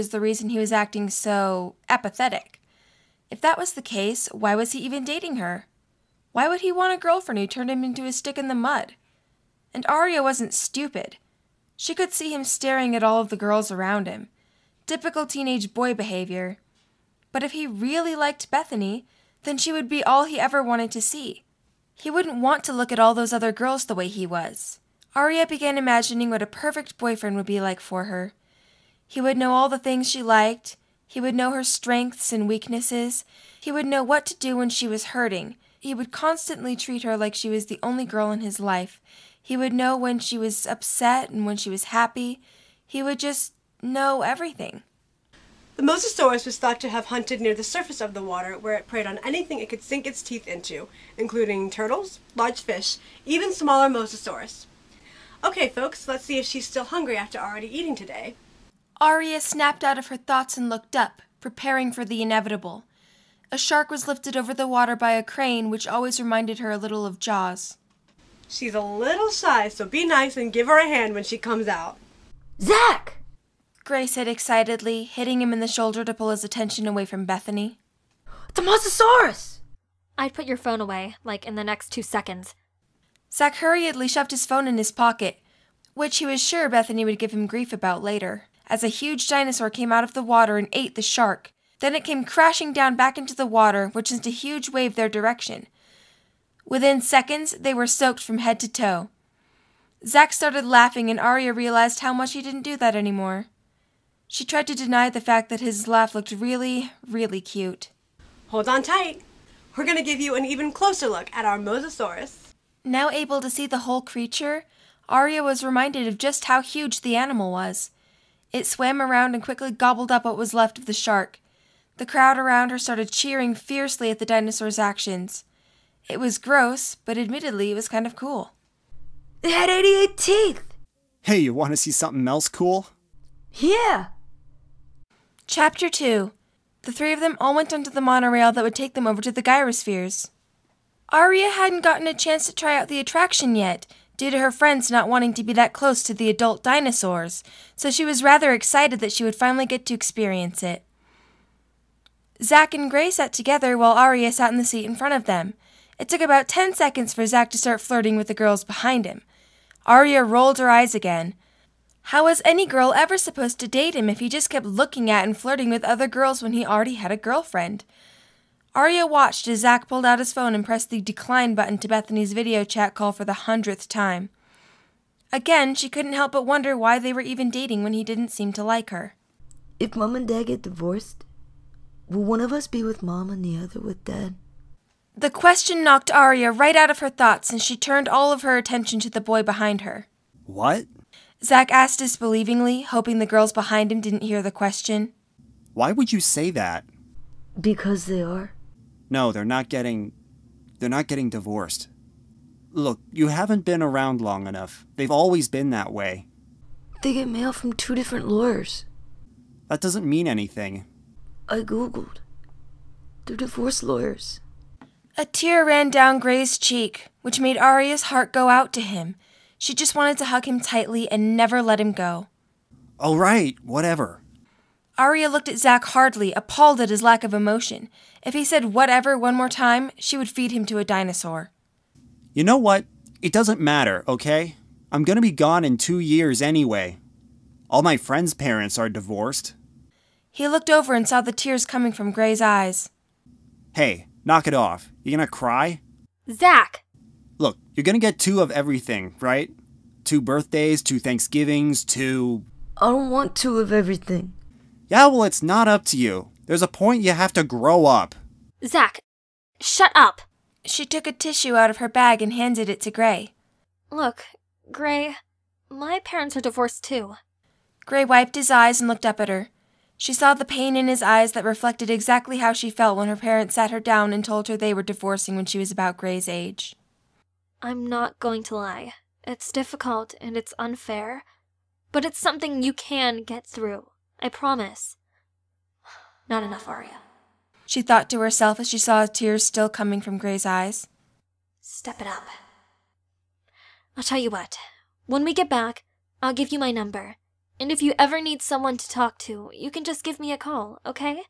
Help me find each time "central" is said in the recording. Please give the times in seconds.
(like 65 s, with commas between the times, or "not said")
not said.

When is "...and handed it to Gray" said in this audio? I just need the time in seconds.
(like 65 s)
262 s.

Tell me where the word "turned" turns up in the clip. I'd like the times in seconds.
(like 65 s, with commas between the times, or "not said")
7 s, 187 s.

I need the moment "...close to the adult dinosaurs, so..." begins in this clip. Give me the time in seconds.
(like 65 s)
145 s.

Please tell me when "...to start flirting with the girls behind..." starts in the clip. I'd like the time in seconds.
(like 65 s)
157 s.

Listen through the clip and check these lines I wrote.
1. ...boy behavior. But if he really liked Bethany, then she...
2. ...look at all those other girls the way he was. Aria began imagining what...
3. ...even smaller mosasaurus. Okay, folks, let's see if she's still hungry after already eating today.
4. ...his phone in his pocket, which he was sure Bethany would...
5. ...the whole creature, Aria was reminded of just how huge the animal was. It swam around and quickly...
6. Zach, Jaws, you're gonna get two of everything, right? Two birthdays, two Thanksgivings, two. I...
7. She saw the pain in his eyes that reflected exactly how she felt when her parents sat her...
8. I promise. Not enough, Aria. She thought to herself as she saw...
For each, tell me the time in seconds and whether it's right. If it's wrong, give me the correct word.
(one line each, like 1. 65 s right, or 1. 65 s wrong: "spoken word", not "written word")
1. 15 s right
2. 22 s right
3. 53 s right
4. 84 s right
5. 113 s right
6. 246 s wrong: "Look", not "Jaws"
7. 269 s right
8. 284 s right.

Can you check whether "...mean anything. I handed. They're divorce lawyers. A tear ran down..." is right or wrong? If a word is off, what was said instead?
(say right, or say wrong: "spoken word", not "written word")
wrong: "googled", not "handed".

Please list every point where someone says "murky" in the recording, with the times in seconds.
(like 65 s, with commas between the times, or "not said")
not said.